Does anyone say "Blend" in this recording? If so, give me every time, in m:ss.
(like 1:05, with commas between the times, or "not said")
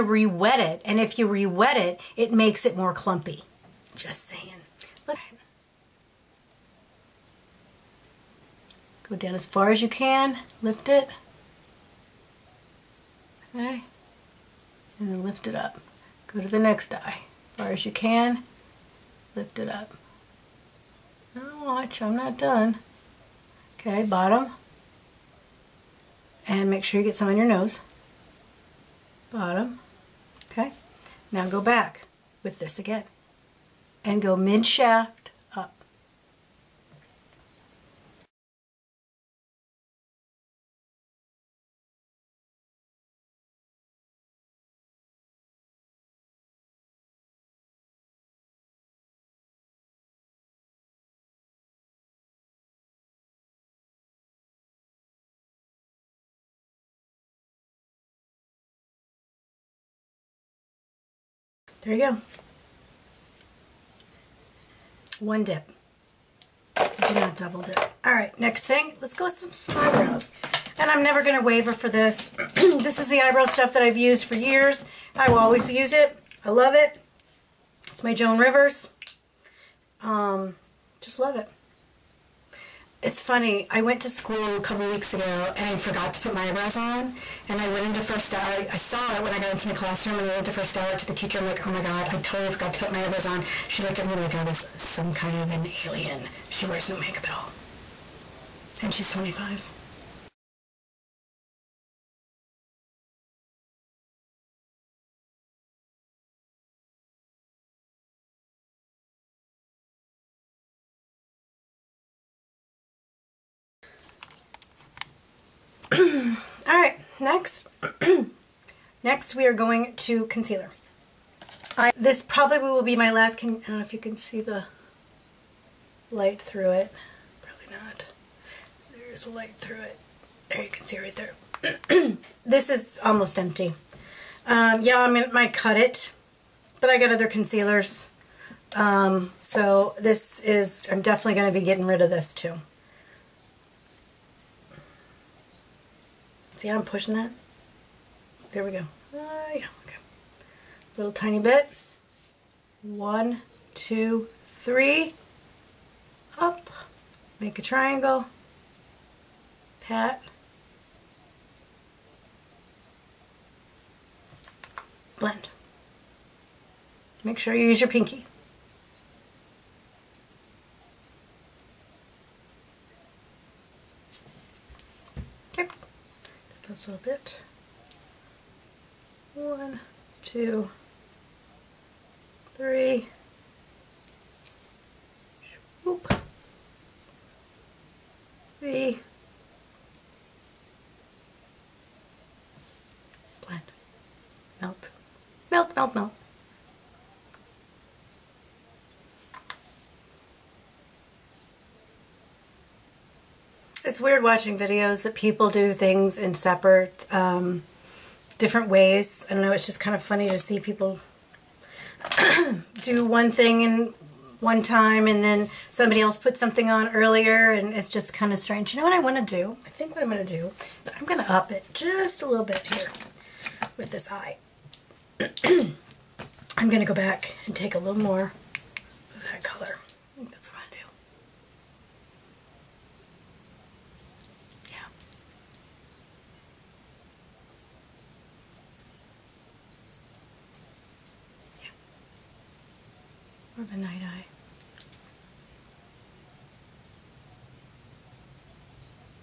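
2:45, 3:13.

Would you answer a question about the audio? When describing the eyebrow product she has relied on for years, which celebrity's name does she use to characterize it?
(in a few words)
Joan Rivers.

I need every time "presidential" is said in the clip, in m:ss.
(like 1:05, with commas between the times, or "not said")
not said.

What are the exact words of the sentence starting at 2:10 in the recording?
There you can see right there.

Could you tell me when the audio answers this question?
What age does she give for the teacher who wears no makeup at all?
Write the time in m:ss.
1:39.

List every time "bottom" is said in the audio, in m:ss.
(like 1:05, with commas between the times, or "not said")
0:24, 0:29.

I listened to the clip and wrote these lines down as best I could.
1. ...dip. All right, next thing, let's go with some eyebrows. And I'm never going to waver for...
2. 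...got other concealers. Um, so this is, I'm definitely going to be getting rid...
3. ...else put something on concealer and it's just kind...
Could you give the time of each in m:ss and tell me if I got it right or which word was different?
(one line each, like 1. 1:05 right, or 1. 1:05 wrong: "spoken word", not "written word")
1. 1:07 right
2. 2:16 right
3. 3:35 wrong: "earlier", not "concealer".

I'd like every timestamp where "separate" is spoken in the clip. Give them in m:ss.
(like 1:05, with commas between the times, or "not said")
3:26.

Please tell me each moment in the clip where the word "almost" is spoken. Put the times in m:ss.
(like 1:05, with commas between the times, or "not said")
2:13.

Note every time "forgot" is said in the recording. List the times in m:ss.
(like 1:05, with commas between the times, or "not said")
1:25, 1:32.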